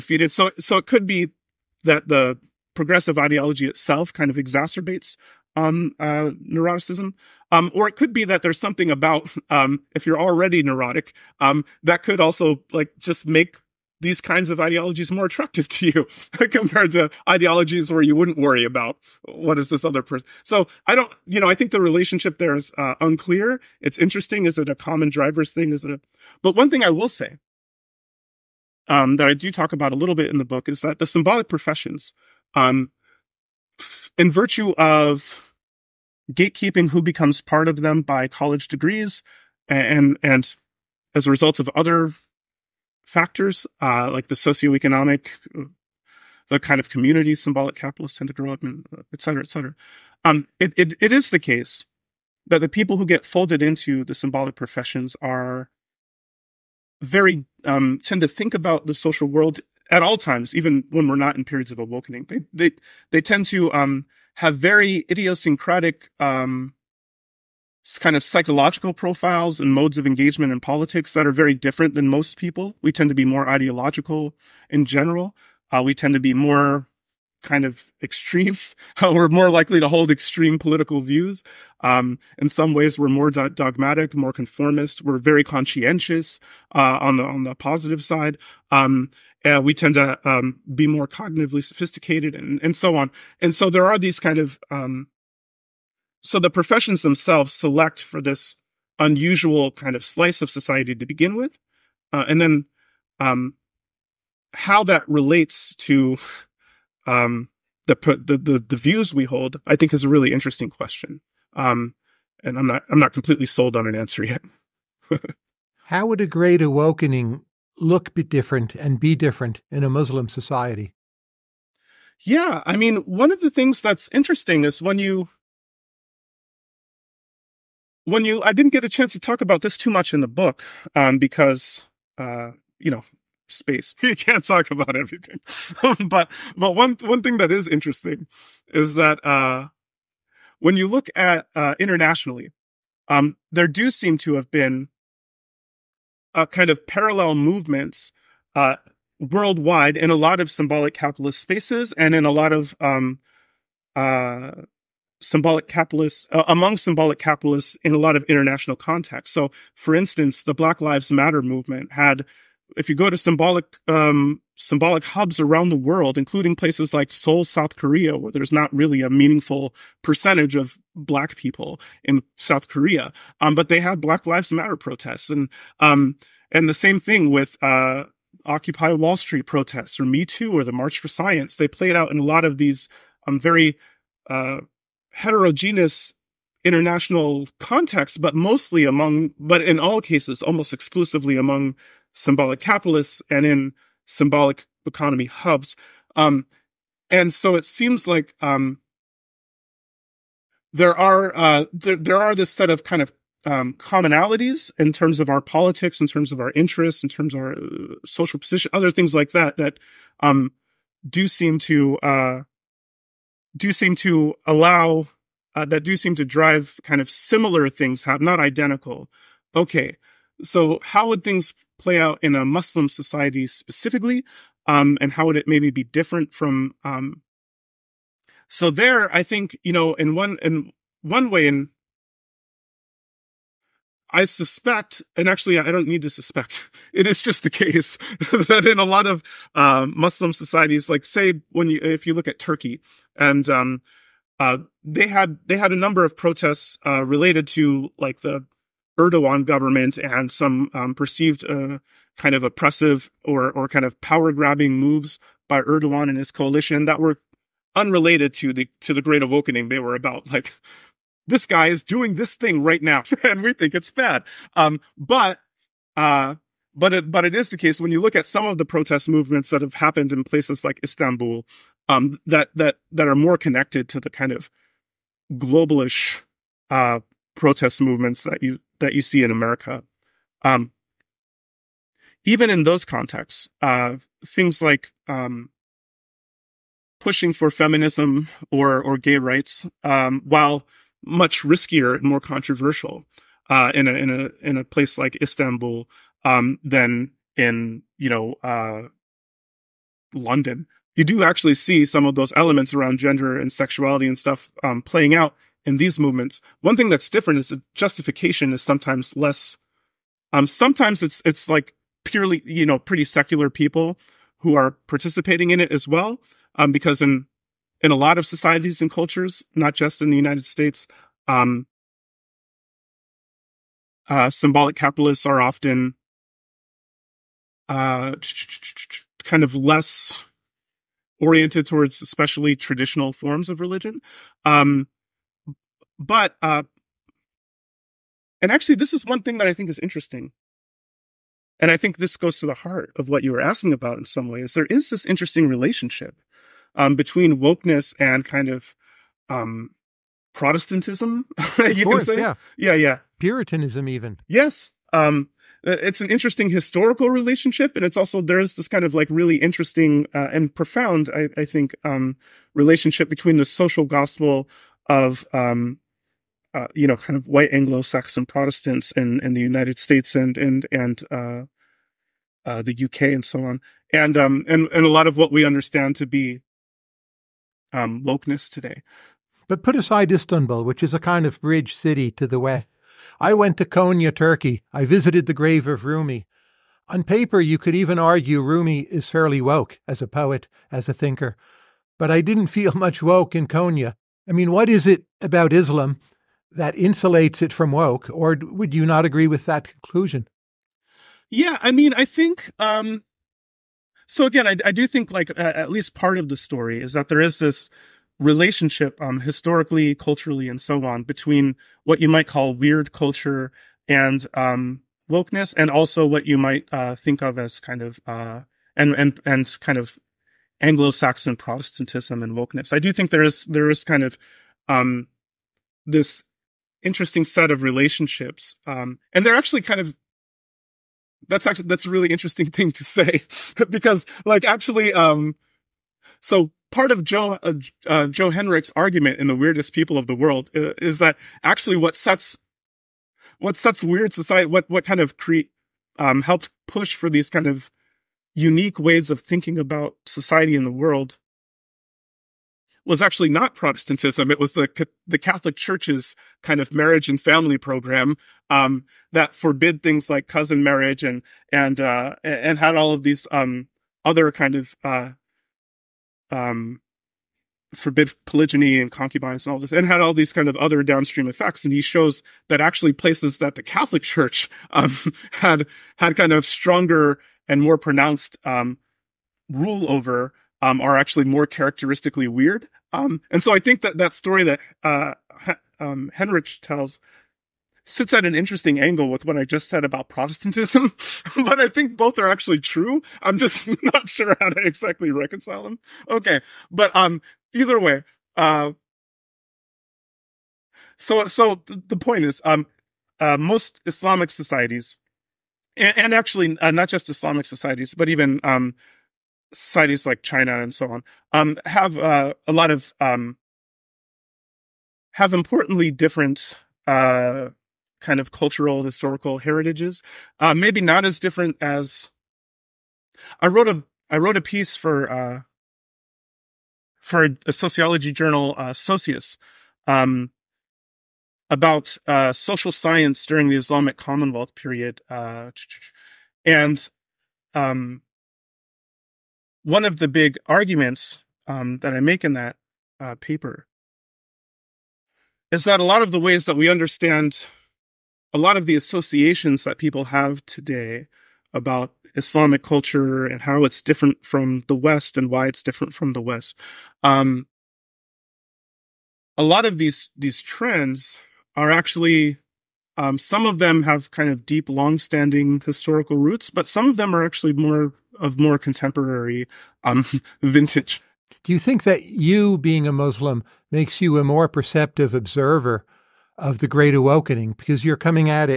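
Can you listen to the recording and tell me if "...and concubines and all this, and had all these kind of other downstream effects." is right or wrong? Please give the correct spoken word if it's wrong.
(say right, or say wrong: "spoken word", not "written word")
right.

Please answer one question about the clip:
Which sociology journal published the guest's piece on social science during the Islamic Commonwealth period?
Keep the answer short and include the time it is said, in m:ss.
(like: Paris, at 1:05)
Socius, at 8:48.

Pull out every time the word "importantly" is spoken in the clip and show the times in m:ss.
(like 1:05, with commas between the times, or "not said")
8:35.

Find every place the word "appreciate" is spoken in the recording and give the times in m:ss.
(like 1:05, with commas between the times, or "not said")
not said.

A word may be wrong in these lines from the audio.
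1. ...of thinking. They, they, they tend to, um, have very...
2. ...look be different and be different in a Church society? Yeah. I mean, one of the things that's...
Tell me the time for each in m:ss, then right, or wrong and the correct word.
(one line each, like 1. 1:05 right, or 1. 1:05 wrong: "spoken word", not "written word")
1. 1:01 wrong: "awakening", not "thinking"
2. 1:57 wrong: "Muslim", not "Church".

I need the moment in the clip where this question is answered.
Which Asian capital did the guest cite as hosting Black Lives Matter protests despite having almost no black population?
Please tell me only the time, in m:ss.
2:47.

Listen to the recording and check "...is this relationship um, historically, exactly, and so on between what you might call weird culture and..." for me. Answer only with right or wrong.
wrong.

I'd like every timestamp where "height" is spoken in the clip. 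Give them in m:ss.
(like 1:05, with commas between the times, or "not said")
not said.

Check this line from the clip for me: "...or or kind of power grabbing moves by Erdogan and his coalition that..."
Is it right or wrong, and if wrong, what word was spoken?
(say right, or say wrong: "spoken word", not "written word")
right.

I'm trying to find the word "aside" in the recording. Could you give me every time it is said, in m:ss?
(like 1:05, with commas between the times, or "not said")
6:19.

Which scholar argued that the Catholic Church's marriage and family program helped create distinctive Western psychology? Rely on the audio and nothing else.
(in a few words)
Joe Henrich.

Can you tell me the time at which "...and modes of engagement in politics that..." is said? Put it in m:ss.
1:09.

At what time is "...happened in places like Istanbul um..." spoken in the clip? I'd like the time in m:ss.
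4:29.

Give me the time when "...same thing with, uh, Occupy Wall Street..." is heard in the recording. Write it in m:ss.
2:56.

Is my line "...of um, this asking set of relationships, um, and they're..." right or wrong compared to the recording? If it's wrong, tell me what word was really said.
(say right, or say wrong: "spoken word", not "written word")
wrong: "interesting", not "asking".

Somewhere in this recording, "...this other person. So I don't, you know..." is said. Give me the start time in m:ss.
0:19.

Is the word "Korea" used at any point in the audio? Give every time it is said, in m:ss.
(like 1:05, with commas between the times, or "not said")
2:47, 2:52.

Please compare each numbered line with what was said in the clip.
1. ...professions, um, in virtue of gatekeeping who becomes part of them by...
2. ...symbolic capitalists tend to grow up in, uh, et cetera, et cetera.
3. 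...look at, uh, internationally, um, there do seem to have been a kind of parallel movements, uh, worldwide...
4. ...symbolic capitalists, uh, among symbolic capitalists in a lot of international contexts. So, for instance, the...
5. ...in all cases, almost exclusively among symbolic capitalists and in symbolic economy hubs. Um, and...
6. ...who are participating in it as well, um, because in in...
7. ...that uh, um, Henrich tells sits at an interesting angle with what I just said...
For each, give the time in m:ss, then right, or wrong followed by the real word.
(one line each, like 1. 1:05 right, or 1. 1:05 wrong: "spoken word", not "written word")
1. 0:31 right
2. 0:47 right
3. 2:20 right
4. 2:35 right
5. 3:09 right
6. 5:14 right
7. 8:04 right.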